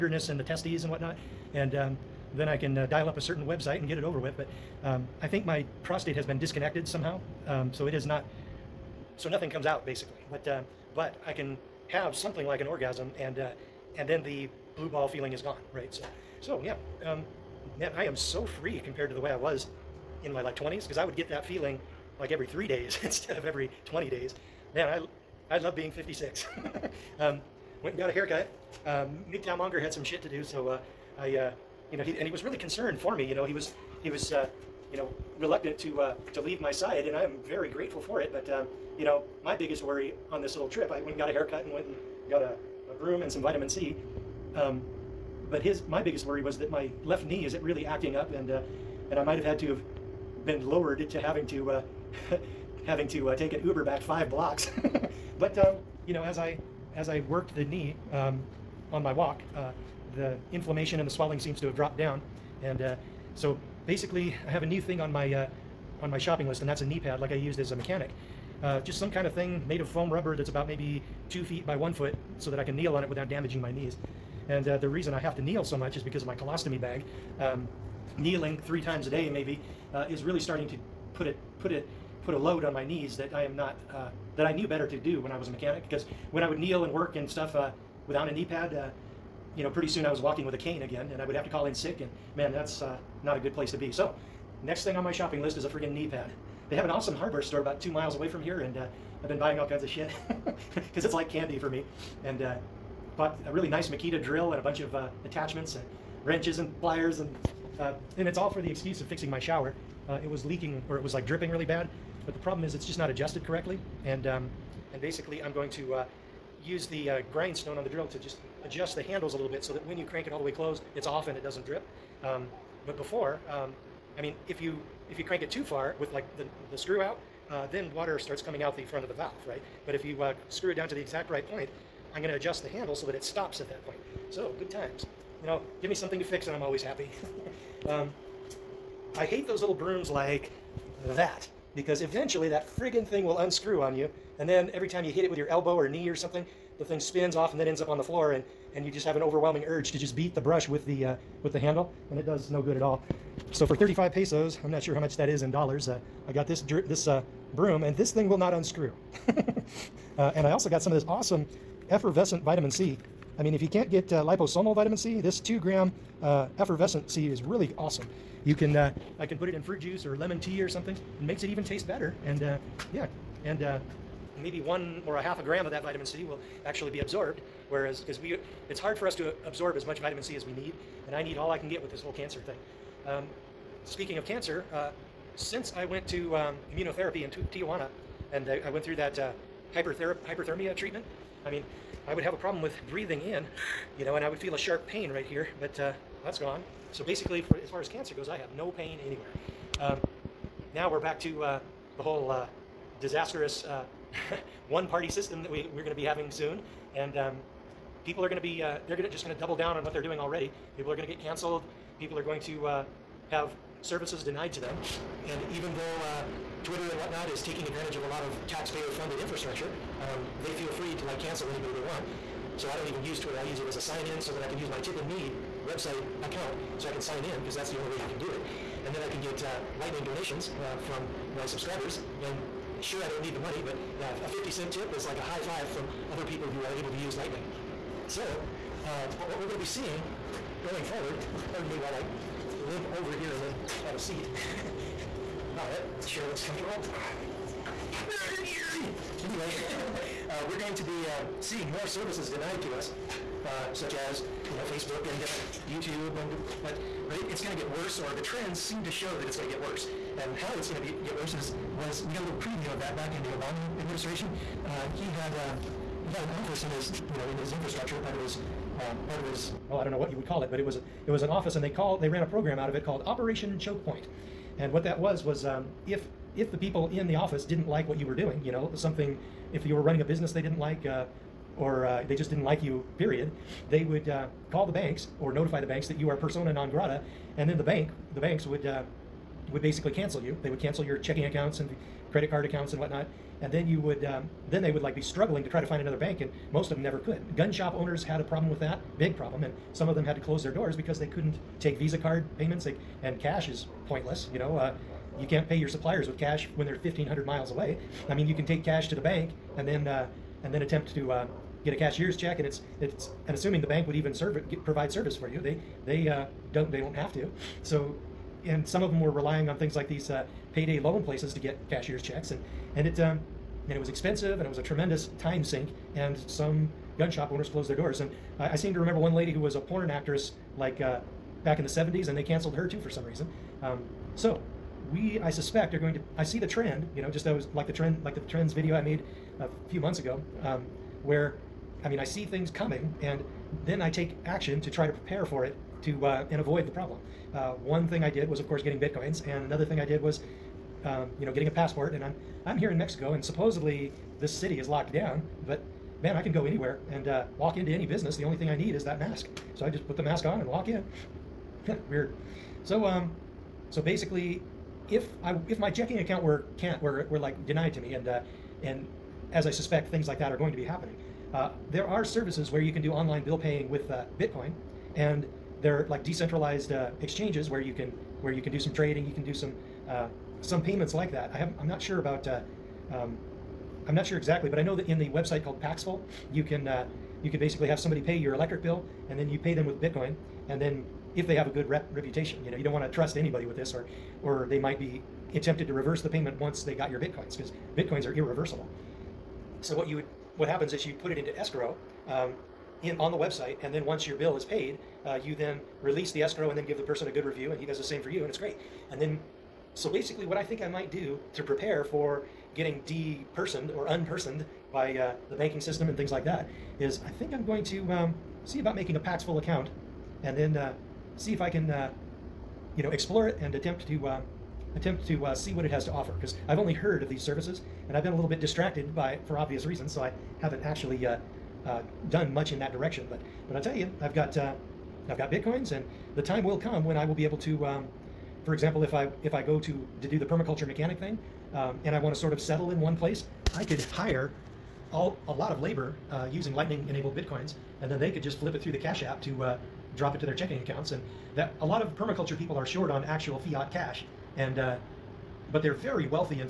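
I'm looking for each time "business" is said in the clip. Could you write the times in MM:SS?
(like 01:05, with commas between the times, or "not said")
04:40, 05:57.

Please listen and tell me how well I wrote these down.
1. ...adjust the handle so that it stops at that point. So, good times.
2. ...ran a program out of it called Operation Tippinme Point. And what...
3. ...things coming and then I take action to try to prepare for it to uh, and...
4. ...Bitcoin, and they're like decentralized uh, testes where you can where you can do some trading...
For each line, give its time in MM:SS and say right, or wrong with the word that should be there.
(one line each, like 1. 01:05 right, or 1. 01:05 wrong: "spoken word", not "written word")
1. 02:12 right
2. 04:32 wrong: "Choke", not "Tippinme"
3. 05:42 right
4. 06:14 wrong: "exchanges", not "testes".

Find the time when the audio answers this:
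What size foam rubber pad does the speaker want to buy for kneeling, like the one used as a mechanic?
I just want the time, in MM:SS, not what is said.
01:11.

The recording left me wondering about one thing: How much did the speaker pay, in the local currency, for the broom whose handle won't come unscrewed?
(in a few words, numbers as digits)
35 pesos.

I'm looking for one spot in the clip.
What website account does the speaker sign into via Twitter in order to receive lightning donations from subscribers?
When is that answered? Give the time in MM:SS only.
03:44.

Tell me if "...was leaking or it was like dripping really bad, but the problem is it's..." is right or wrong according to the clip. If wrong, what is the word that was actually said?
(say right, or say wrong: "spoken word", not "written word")
right.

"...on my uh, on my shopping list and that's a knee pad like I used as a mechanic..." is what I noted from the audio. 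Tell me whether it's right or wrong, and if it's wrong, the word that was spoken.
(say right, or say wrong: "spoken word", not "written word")
right.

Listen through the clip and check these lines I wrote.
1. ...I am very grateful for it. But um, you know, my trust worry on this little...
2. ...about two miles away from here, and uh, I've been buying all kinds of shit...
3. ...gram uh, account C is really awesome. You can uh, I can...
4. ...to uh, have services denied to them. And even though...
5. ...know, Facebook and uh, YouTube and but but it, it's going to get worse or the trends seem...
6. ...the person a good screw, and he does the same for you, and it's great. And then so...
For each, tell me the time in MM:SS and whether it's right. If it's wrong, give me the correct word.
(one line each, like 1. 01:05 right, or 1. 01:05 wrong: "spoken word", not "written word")
1. 00:37 wrong: "biggest", not "trust"
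2. 01:37 right
3. 02:45 wrong: "effervescent", not "account"
4. 03:32 right
5. 04:14 right
6. 06:46 wrong: "review", not "screw".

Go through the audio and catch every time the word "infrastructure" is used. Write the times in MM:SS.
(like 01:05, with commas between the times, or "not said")
03:39, 04:27.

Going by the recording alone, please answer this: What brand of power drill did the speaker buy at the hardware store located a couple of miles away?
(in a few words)
Makita.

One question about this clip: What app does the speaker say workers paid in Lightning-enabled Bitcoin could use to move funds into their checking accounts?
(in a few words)
Cash App.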